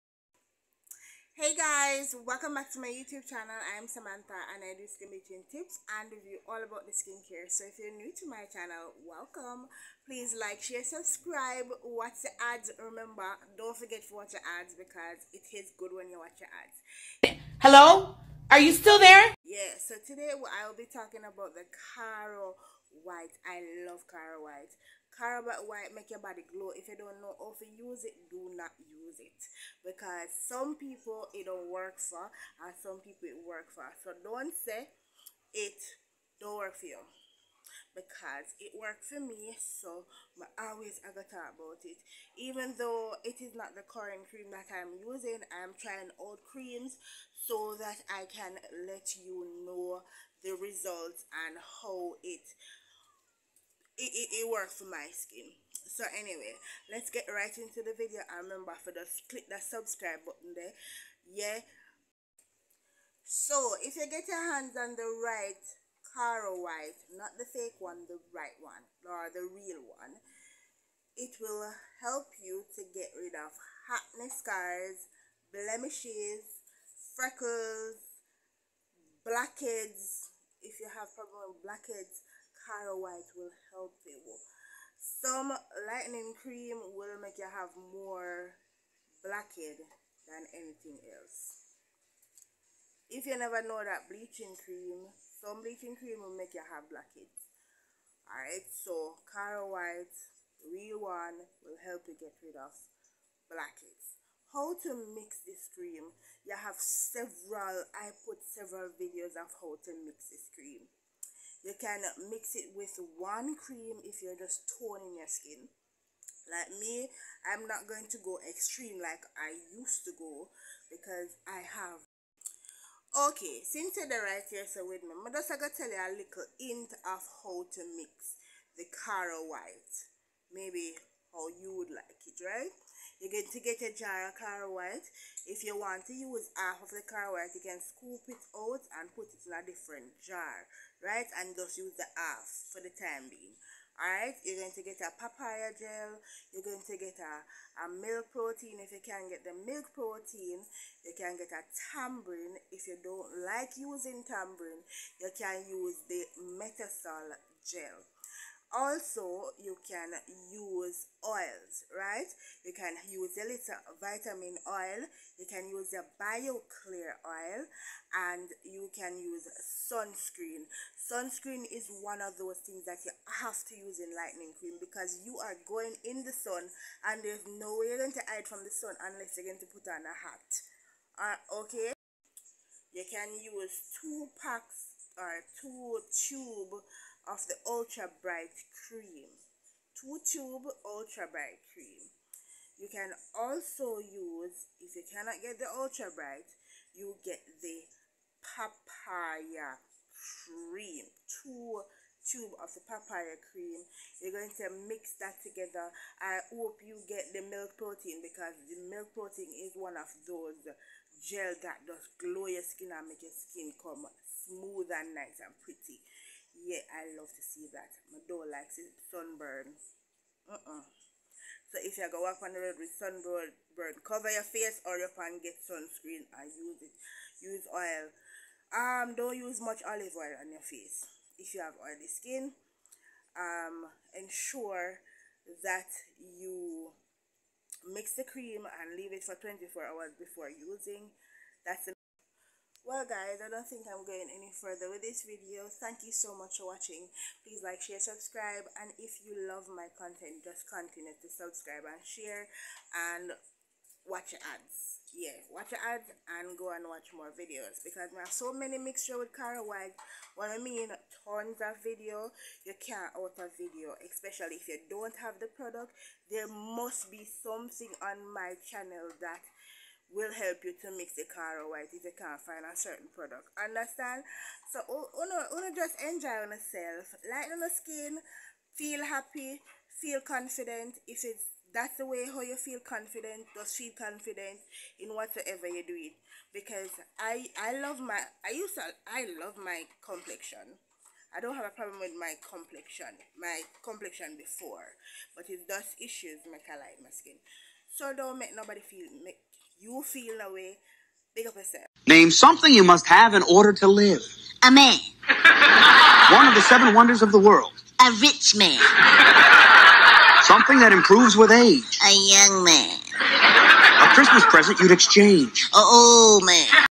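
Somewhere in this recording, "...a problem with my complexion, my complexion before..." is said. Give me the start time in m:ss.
4:51.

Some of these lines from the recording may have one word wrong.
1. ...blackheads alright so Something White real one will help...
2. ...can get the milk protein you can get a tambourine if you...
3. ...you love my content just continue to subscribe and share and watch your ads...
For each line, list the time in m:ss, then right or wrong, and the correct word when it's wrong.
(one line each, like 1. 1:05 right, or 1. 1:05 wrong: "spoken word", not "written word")
1. 1:36 wrong: "Caro", not "Something"
2. 2:29 right
3. 4:09 right.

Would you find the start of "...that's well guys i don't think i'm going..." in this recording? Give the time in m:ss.
4:01.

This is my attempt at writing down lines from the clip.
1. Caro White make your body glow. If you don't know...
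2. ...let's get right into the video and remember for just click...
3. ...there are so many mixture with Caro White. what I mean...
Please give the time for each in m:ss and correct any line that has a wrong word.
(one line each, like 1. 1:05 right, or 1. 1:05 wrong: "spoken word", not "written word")
1. 0:25 right
2. 0:56 right
3. 4:18 right.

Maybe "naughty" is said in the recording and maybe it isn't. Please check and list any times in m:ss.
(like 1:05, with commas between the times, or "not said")
not said.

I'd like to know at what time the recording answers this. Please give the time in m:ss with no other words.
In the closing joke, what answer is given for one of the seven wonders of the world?
5:07.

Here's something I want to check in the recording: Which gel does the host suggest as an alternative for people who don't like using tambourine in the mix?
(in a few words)
metasol gel.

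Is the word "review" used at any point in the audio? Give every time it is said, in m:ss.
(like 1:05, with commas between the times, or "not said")
0:06.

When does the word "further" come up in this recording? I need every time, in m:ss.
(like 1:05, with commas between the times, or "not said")
4:04.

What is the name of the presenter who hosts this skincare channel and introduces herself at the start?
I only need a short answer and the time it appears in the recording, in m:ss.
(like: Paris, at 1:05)
Samantha, at 0:03.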